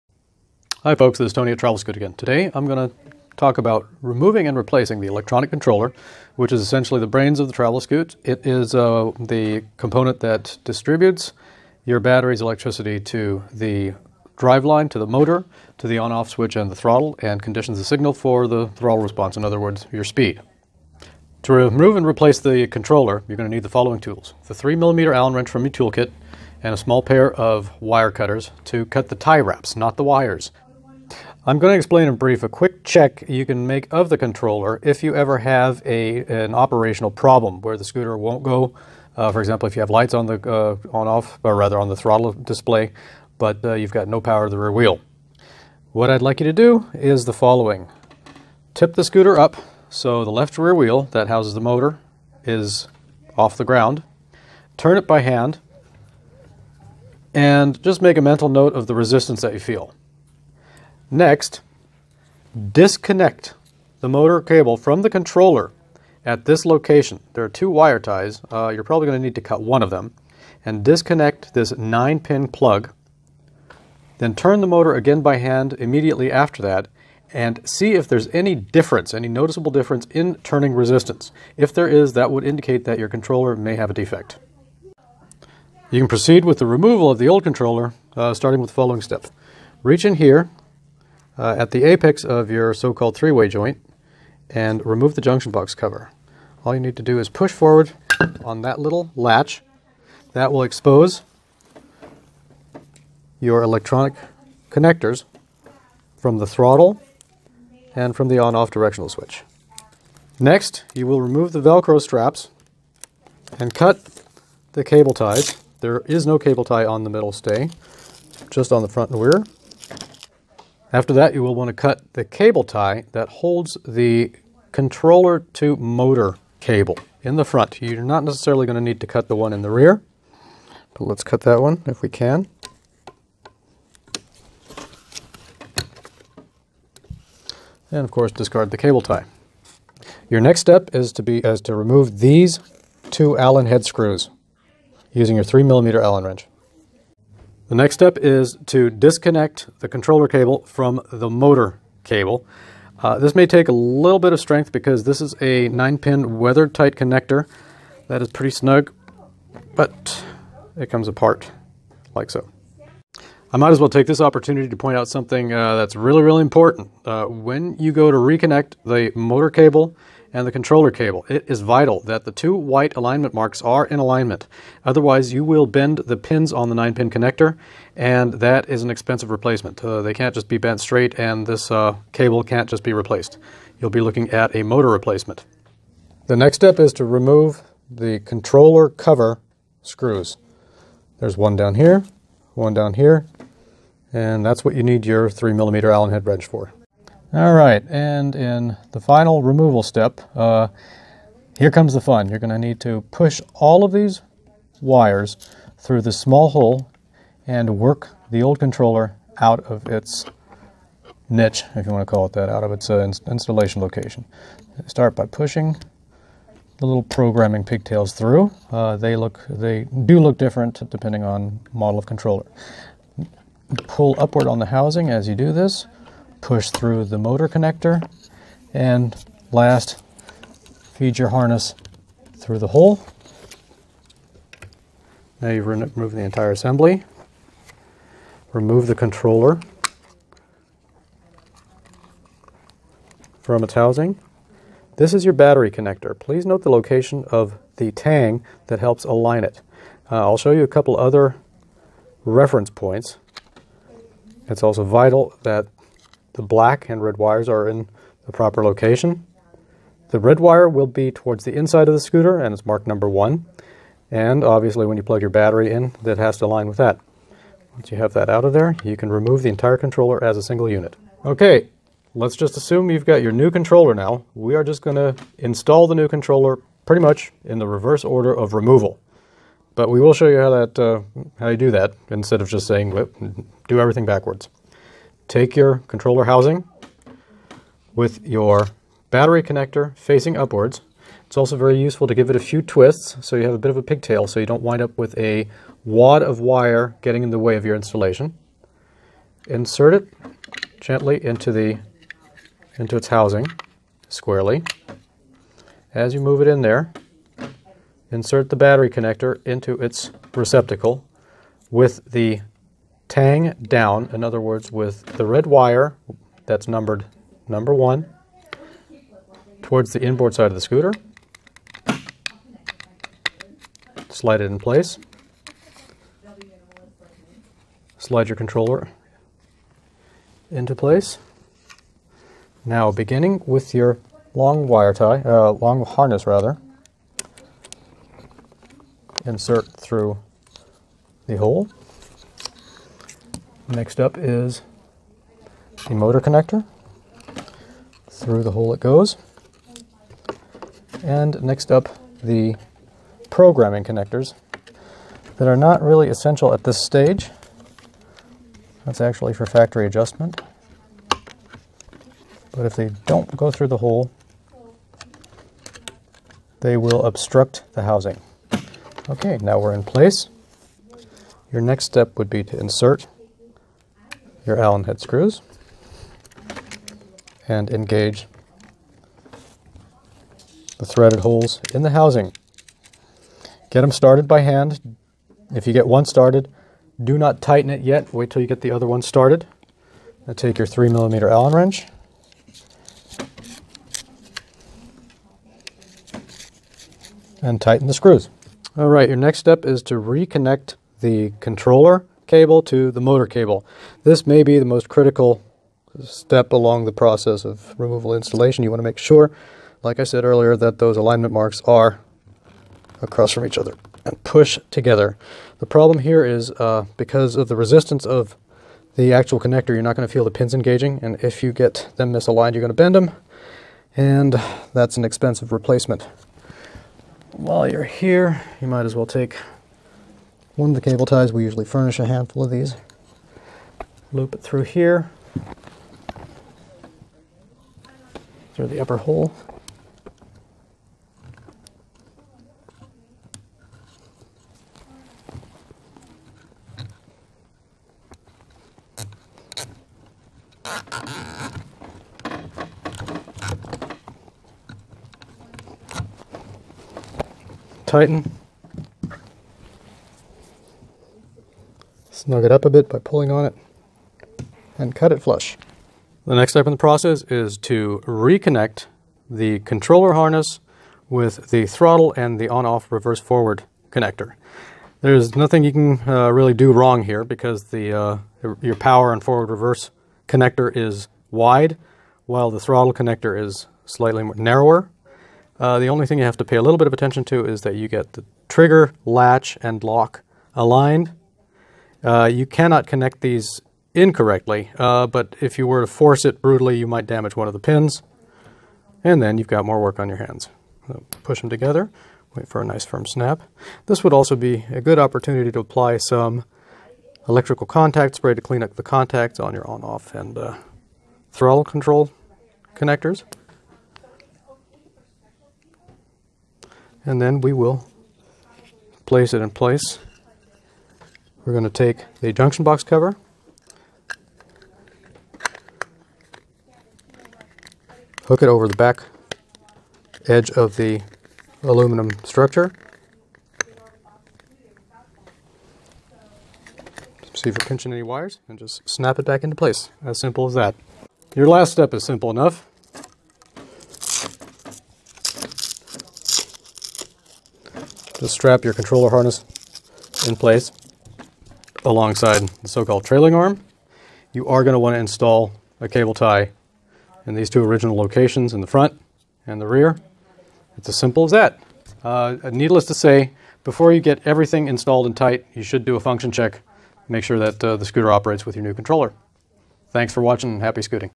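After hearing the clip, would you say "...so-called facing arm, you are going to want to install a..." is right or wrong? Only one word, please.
wrong.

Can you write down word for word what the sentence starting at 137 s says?
And of course, discard the cable tie.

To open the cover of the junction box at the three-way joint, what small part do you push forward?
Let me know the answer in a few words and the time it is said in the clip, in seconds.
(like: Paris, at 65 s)
little latch, at 98 s.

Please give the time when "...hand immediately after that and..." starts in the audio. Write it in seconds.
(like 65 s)
75 s.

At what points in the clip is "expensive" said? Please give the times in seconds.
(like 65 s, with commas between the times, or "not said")
178 s, 425 s.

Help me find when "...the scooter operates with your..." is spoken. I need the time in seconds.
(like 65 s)
567 s.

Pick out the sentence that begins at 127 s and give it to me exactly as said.
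You're not necessarily going to need to cut the one in the rear, but let's cut that one if we can.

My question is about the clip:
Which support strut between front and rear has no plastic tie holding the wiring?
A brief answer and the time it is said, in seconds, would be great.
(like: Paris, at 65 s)
the middle stay, at 117 s.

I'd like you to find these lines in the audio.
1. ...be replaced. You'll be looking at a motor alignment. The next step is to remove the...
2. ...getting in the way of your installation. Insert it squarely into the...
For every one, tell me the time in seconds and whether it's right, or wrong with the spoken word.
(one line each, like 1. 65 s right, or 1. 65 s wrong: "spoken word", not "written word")
1. 182 s wrong: "replacement", not "alignment"
2. 297 s wrong: "gently", not "squarely".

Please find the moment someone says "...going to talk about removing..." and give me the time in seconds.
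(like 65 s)
2 s.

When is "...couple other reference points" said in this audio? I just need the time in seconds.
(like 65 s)
250 s.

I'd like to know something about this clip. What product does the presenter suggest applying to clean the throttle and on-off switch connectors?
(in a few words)
electrical contact spray.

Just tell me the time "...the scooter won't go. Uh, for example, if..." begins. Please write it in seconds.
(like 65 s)
37 s.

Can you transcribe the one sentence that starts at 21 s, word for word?
To remove and replace the controller, you're going to need the following tools.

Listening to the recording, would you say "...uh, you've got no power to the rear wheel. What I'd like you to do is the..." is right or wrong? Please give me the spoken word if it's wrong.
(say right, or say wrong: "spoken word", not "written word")
right.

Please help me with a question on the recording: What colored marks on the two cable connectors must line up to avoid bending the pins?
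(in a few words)
white alignment marks.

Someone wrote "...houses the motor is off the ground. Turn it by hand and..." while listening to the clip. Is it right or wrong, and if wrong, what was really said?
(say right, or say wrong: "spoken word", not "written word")
right.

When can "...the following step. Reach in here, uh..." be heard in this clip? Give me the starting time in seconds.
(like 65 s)
88 s.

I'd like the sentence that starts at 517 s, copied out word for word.
And then we will place it in place.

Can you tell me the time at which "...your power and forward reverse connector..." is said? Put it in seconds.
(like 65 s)
478 s.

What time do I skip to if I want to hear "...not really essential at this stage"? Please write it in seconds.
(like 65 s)
355 s.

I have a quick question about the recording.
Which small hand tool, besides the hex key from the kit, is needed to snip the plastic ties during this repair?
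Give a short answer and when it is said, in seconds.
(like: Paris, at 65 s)
wire cutters, at 27 s.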